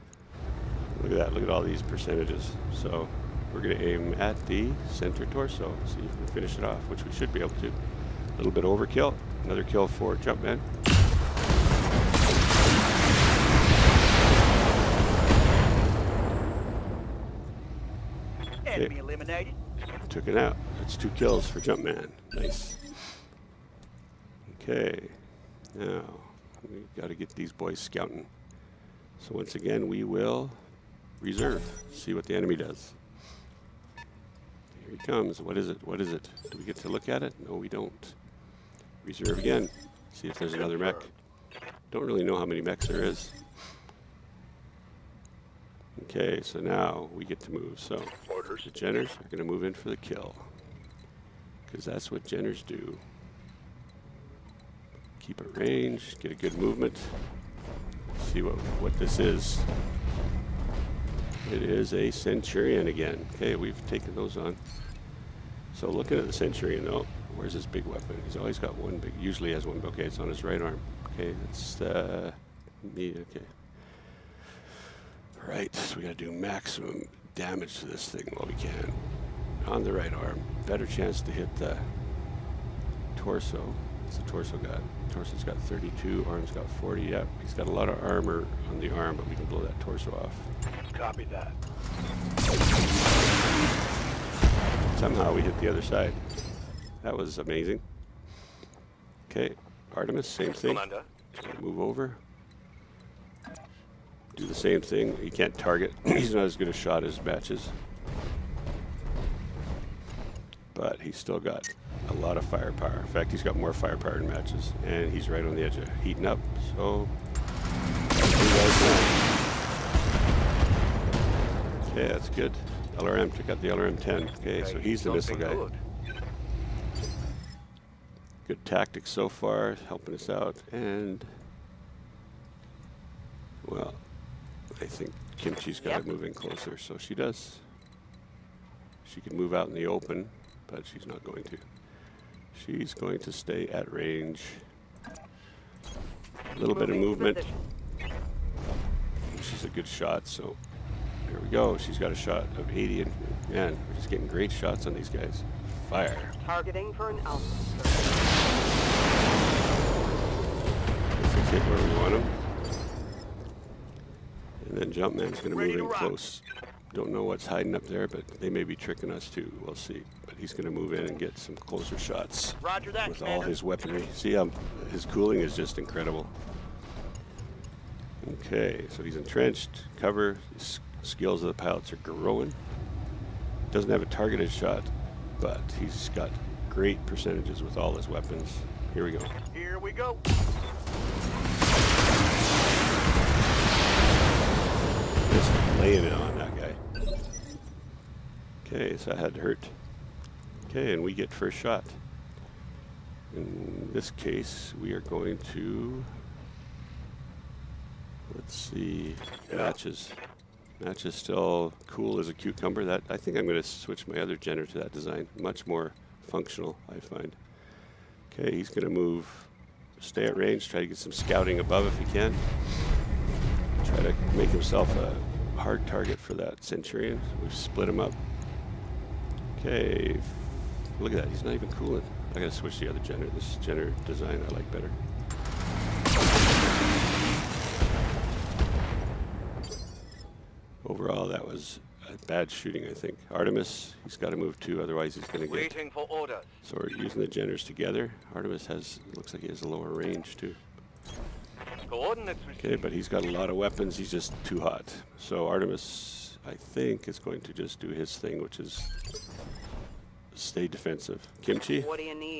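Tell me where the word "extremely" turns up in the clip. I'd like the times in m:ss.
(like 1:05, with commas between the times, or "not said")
not said.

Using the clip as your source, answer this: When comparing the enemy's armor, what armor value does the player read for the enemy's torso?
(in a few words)
32.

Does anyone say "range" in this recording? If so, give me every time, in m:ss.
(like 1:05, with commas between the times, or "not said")
0:55, 2:23, 3:40, 4:09.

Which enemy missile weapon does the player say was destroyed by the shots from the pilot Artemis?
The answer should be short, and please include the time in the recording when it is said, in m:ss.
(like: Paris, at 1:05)
LRM-10, at 2:03.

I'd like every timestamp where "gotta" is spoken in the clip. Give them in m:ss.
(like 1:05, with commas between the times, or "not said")
1:16, 3:52.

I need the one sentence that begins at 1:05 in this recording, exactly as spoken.
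So looking at the Centurion though, where's his big weapon?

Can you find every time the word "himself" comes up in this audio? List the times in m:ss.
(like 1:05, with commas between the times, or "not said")
3:44.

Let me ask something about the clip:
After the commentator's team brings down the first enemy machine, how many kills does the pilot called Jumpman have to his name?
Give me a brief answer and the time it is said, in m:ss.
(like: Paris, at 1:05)
2, at 0:20.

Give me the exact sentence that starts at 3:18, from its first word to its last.
Okay, so that had to hurt.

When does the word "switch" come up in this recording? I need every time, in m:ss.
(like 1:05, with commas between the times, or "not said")
3:33, 3:52.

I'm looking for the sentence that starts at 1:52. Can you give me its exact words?
In fact, he's got more firepower than matches, and he's right on the edge of heating up.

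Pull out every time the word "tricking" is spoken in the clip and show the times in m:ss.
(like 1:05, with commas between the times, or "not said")
2:48.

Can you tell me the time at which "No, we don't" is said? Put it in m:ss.
0:37.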